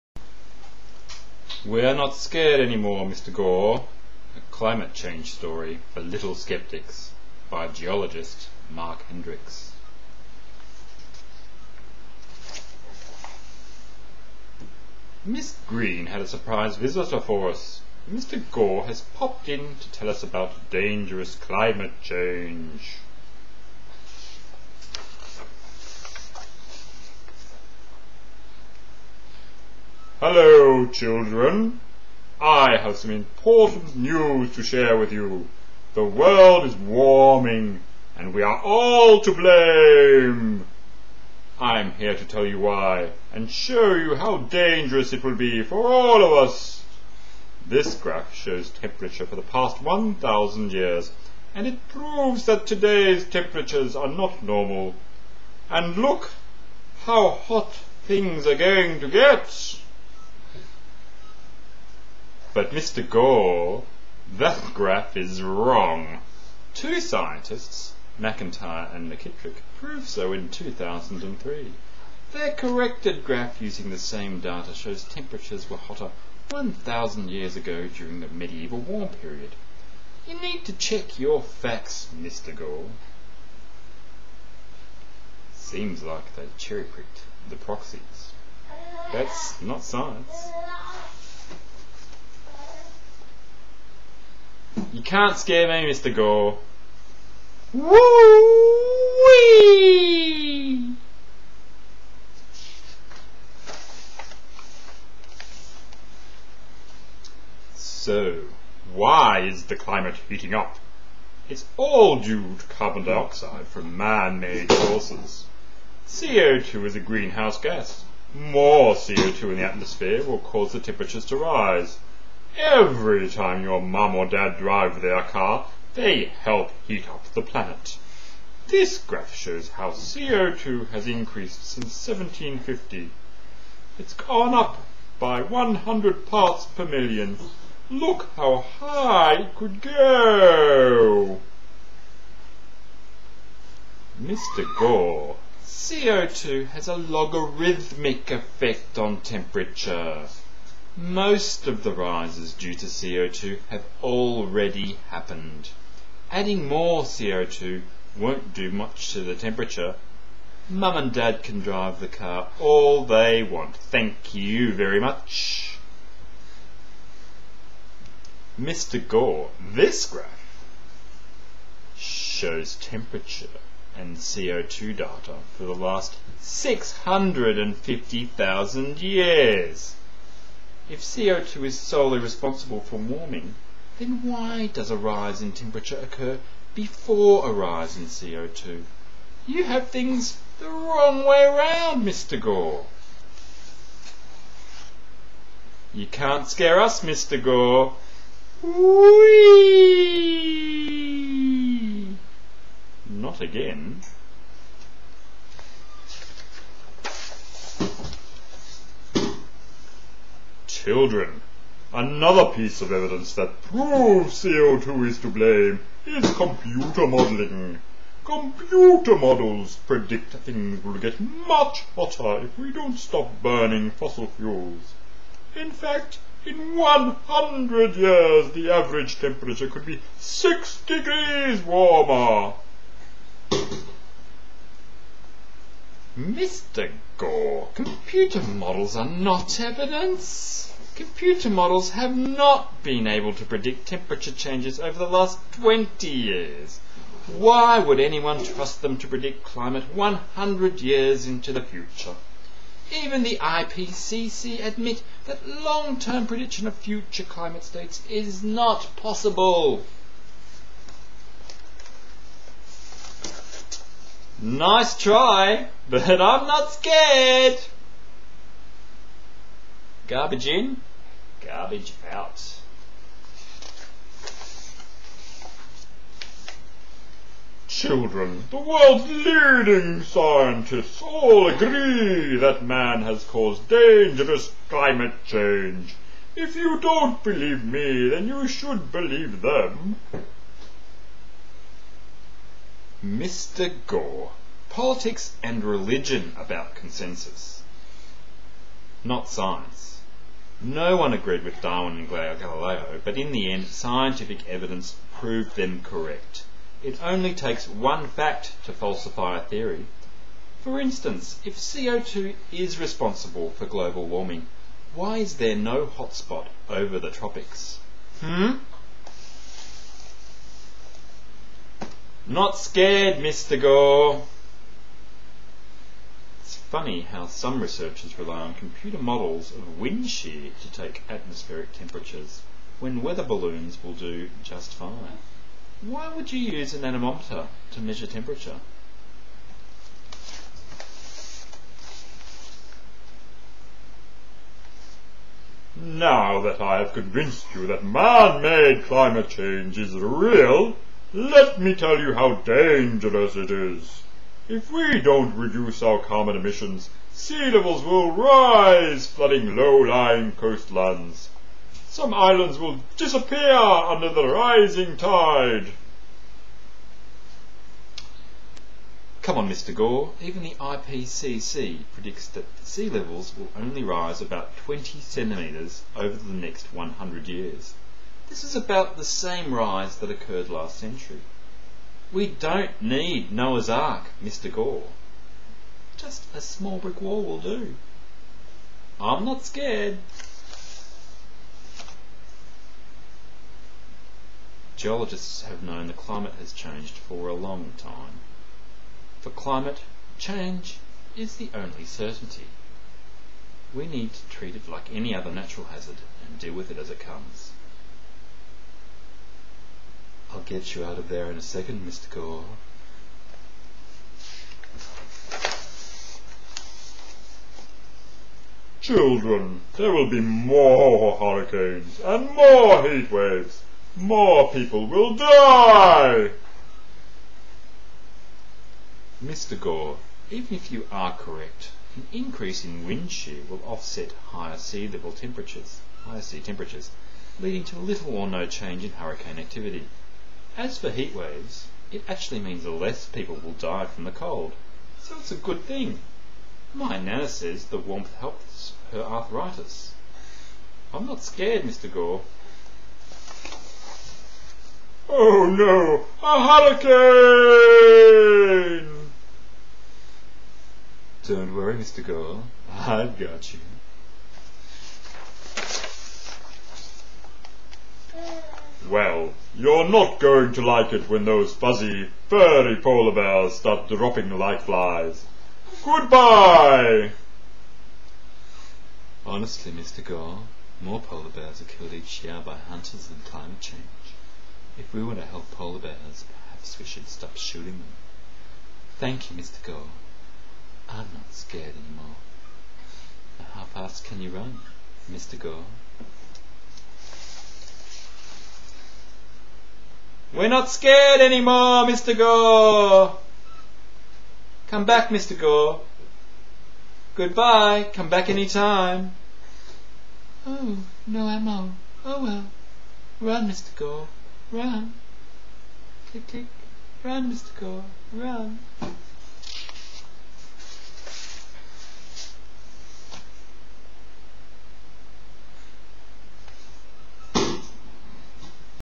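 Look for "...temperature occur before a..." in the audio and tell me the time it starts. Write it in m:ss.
3:05.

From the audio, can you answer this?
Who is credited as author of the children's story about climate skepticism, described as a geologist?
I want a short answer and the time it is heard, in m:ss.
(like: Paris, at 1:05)
Marc Hendrickx, at 0:08.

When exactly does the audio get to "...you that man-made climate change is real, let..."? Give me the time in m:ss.
5:47.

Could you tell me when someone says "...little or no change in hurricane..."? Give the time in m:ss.
7:17.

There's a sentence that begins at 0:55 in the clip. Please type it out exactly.
And look how hot things are going to get.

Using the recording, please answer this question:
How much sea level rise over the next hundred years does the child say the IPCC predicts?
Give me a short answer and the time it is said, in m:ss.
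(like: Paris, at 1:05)
20 centimetres, at 6:14.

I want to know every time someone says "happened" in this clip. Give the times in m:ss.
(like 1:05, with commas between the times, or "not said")
2:35.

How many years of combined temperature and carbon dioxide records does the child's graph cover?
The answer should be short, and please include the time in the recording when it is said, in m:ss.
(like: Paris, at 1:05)
650,000 years, at 2:56.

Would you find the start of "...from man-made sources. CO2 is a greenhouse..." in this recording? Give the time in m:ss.
1:53.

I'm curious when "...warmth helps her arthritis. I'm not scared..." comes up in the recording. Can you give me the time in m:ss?
7:27.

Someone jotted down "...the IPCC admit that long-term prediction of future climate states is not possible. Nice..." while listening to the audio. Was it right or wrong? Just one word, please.
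right.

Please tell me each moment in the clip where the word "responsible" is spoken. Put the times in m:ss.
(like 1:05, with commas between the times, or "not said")
3:02, 5:12.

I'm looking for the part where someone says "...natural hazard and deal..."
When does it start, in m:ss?
6:45.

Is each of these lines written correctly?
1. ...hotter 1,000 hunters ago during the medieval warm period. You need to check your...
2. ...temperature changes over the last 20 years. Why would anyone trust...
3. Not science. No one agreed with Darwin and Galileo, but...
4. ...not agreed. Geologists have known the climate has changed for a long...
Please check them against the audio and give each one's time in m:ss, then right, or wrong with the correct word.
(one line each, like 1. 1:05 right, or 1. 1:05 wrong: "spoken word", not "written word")
1. 1:15 wrong: "years", not "hunters"
2. 4:03 right
3. 4:59 right
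4. 6:29 wrong: "scared", not "agreed".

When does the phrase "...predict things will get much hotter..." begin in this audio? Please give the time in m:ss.
3:39.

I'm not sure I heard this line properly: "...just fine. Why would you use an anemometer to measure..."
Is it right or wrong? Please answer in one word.
right.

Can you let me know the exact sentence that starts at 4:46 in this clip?
If you don't believe me, then you should believe them.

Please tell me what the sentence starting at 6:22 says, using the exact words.
We don't need Noah's Ark, Mr.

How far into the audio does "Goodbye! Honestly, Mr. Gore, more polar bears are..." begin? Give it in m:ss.
7:55.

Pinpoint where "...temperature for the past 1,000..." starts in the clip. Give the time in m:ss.
0:48.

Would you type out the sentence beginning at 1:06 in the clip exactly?
Two scientists, McIntyre and McKitrick, proved so in 2003.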